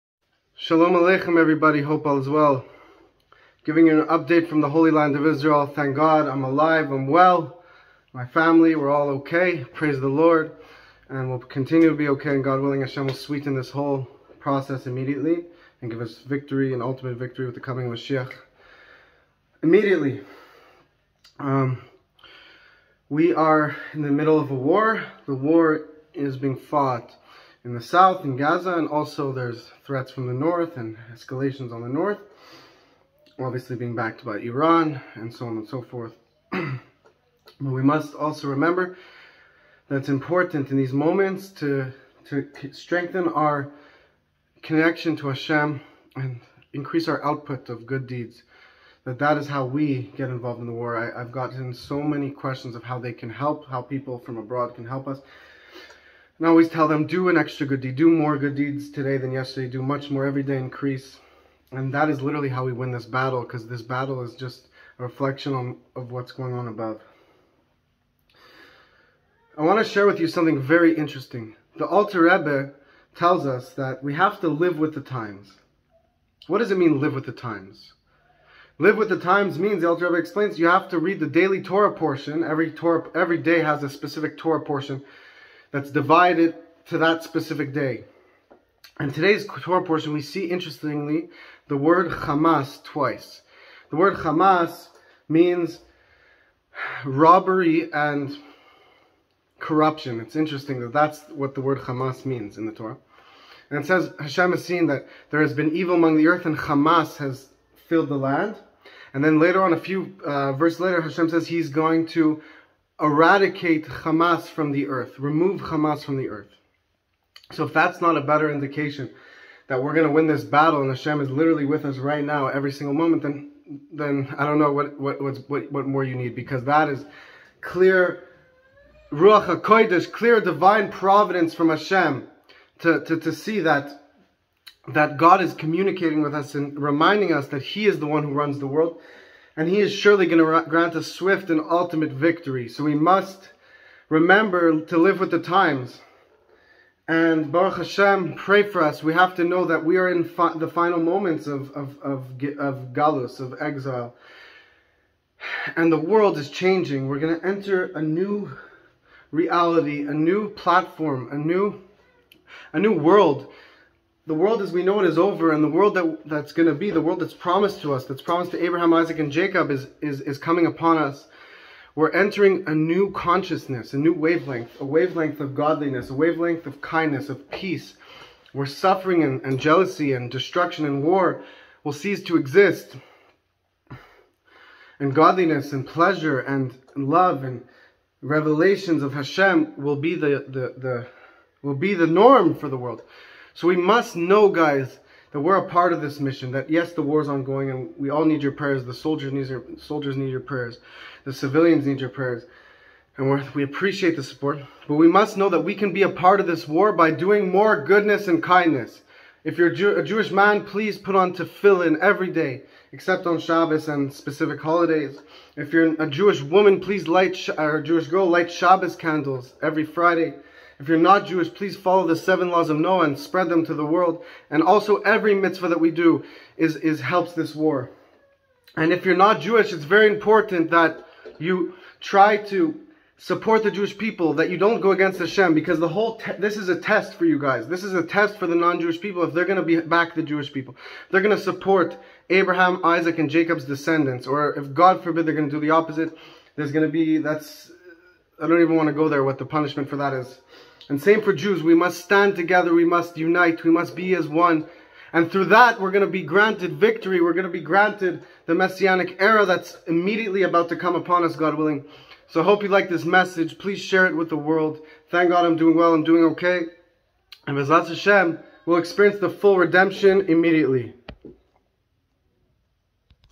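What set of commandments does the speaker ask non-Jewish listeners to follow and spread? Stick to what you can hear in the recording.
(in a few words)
Seven laws of Noah.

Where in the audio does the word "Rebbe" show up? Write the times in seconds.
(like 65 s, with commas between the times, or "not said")
72 s, 80 s.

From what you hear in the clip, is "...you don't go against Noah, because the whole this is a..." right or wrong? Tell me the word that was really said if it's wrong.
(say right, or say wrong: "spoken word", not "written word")
wrong: "Hashem", not "Noah".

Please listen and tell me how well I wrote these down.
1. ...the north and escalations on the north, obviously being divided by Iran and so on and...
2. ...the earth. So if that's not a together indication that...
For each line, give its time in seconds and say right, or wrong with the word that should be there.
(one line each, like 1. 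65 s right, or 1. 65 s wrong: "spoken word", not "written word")
1. 30 s wrong: "backed", not "divided"
2. 116 s wrong: "better", not "together".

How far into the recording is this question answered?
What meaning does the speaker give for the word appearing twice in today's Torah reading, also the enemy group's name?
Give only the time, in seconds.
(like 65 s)
97 s.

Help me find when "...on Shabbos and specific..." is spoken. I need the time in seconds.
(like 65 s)
213 s.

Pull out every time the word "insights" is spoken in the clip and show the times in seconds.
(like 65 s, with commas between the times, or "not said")
not said.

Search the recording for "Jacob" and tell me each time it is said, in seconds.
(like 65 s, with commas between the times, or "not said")
169 s, 243 s.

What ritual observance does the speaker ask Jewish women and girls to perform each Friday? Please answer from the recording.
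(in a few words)
Light Shabbos candles.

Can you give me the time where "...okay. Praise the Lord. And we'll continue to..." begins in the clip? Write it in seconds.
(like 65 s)
9 s.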